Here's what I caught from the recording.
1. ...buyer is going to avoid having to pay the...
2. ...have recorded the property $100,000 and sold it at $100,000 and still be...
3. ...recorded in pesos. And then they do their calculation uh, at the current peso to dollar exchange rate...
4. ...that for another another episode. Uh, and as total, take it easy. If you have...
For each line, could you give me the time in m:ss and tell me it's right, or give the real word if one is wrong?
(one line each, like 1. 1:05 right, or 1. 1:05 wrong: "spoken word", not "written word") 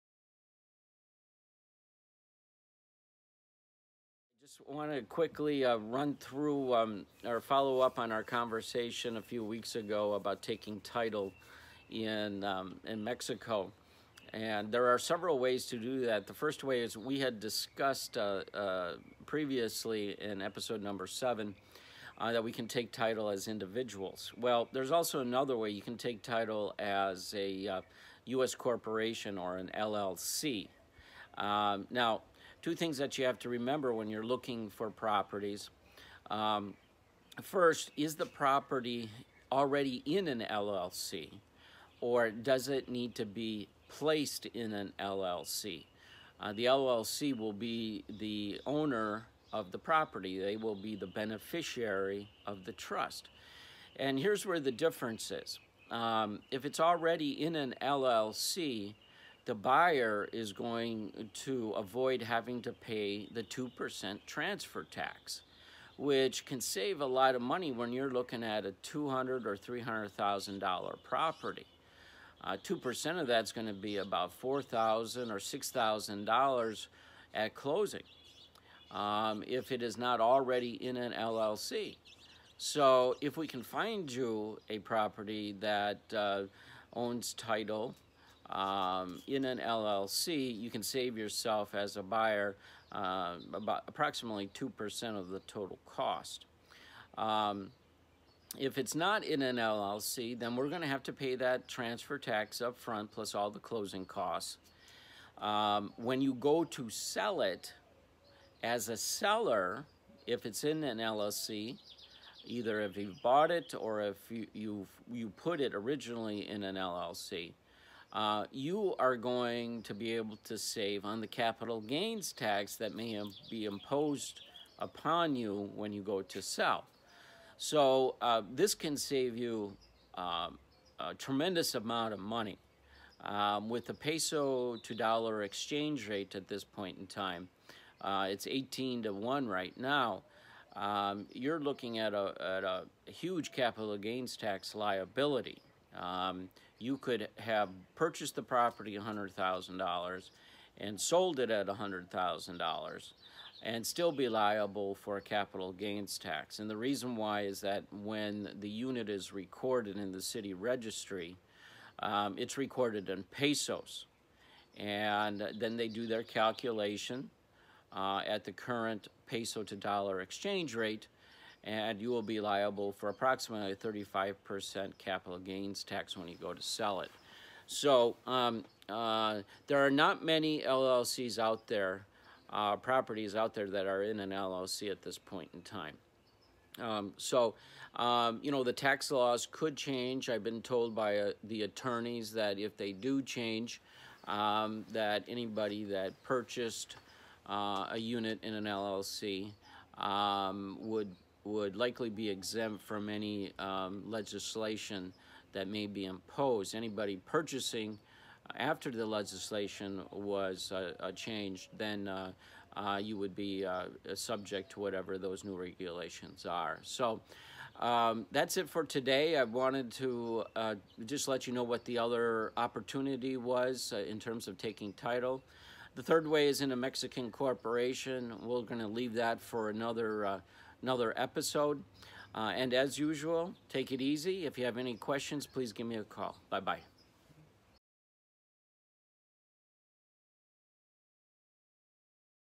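1. 0:59 right
2. 2:27 wrong: "purchased", not "recorded"
3. 2:42 right
4. 3:49 wrong: "usual", not "total".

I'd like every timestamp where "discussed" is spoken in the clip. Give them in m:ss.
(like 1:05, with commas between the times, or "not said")
0:17.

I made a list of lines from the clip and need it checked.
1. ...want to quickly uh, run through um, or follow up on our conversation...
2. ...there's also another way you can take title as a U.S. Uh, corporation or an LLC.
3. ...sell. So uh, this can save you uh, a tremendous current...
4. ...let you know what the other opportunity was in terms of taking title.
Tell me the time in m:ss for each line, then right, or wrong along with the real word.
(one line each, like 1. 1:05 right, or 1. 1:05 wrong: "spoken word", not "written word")
1. 0:04 right
2. 0:24 right
3. 2:06 wrong: "amount", not "current"
4. 3:41 right.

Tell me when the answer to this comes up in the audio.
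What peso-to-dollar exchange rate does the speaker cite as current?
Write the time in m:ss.
2:18.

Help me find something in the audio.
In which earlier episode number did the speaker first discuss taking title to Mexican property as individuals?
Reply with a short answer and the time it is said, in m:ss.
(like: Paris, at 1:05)
7, at 0:20.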